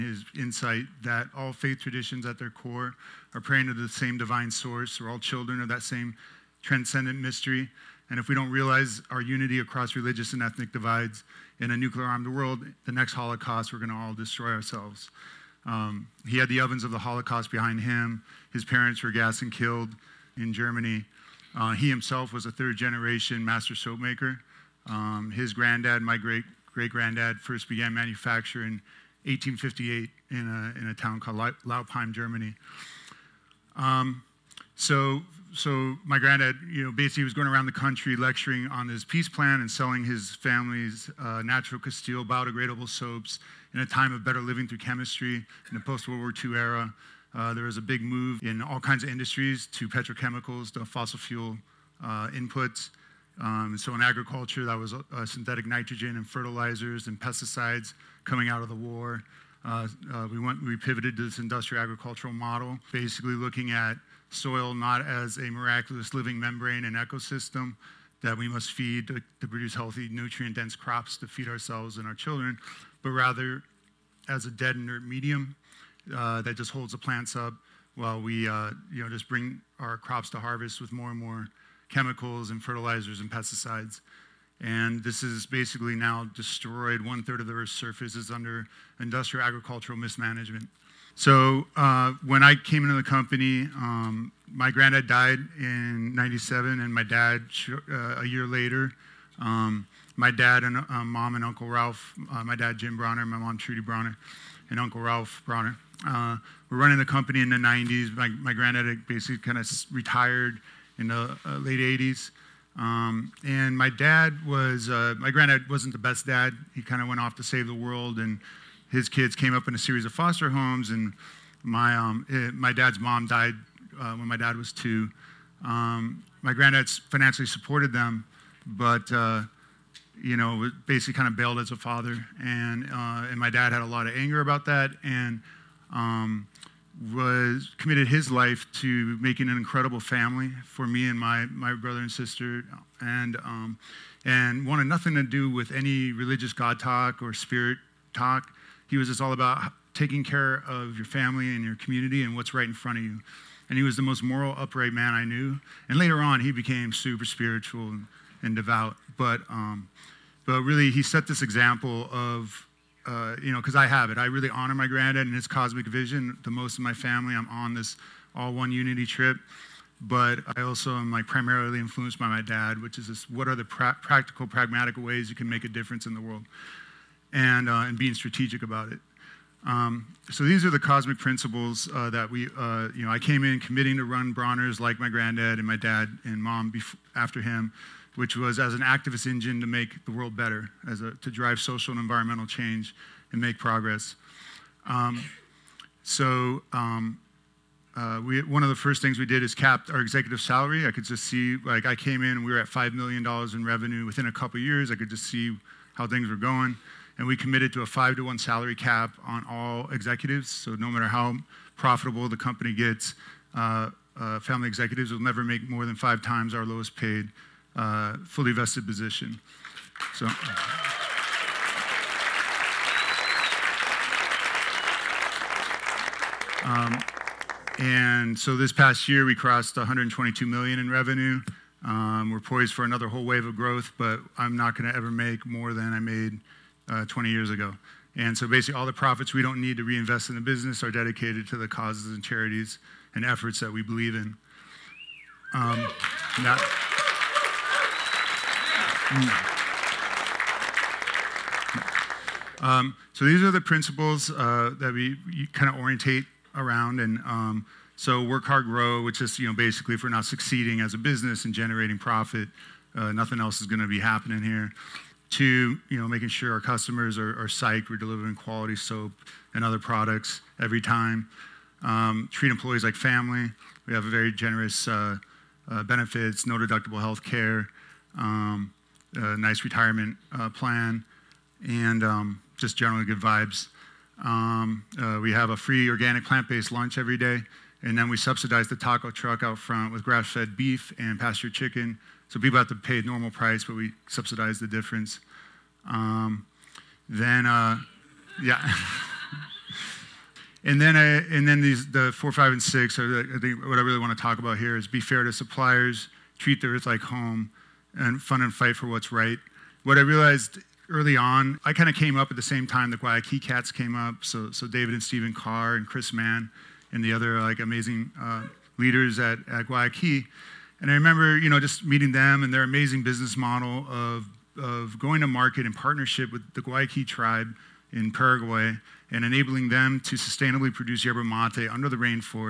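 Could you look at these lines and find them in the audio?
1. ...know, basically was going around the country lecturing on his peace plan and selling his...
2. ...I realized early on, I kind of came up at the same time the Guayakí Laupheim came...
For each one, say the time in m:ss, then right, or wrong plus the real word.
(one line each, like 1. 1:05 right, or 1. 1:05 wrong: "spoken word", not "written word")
1. 0:36 right
2. 5:09 wrong: "Cats", not "Laupheim".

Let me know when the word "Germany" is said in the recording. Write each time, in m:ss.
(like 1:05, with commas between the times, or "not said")
0:20, 0:32.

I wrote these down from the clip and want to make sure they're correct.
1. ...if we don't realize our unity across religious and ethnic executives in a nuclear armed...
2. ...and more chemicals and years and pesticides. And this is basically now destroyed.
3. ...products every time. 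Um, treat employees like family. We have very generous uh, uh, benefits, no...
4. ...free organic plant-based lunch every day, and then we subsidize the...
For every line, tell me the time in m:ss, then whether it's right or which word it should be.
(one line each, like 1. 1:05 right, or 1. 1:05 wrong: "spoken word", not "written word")
1. 0:08 wrong: "divides", not "executives"
2. 1:21 wrong: "fertilizers", not "years"
3. 4:29 right
4. 4:45 right.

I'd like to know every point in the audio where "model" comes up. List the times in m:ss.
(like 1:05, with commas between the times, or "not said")
1:02, 5:23.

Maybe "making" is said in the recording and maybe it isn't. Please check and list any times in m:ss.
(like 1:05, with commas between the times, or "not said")
2:19, 4:26.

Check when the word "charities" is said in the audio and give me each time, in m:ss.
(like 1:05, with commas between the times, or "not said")
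4:02.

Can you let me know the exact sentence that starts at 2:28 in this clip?
He was just all about taking care of your family and your community and what's right in front of you.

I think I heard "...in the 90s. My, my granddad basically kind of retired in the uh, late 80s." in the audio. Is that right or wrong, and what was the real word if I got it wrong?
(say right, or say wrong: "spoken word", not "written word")
right.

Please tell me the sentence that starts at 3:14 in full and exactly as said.
Um, so um, uh, we, one of the first things we did is capped our executive salary.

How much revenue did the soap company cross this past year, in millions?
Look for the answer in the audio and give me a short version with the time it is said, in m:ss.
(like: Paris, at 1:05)
122 million, at 3:49.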